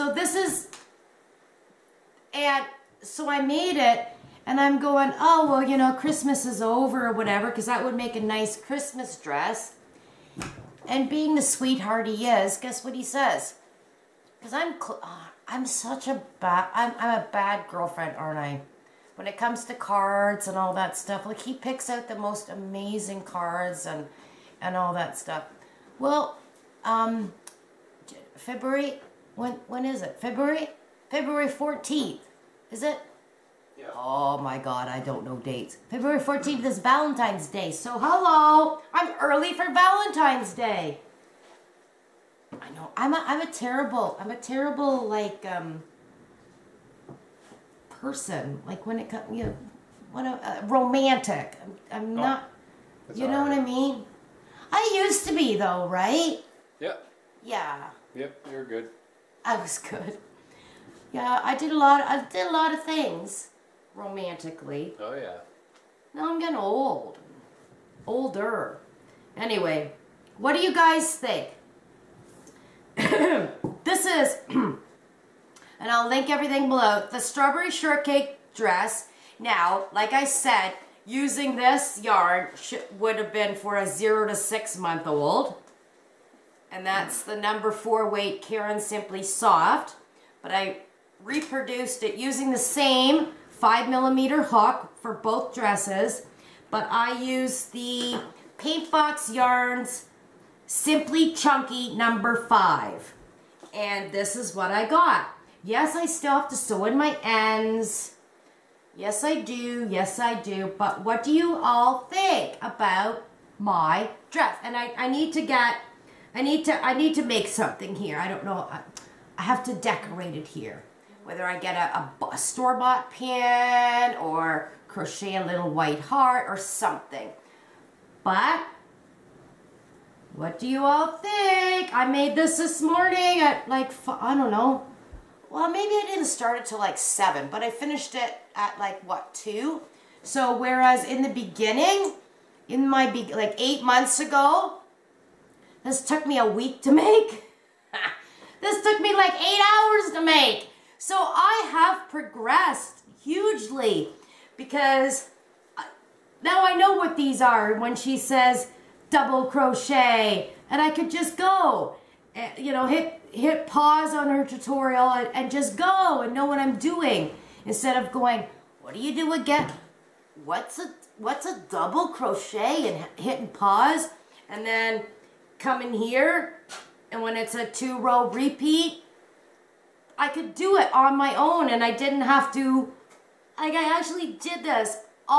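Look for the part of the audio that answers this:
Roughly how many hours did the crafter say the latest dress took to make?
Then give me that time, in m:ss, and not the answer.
2:29.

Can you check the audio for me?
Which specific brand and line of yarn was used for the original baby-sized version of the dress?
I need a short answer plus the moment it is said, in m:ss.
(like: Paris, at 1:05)
Caron Simply Soft, at 1:28.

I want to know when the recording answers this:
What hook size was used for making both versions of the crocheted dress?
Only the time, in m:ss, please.
1:33.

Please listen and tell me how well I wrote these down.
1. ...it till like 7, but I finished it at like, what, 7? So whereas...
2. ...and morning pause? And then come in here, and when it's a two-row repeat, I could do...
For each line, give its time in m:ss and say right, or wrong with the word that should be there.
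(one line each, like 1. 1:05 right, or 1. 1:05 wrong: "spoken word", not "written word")
1. 2:16 wrong: "2", not "7"
2. 2:52 wrong: "hitting", not "morning".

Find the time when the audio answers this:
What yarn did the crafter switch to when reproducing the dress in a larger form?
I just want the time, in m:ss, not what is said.
1:38.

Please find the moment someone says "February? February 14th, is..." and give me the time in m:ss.
0:30.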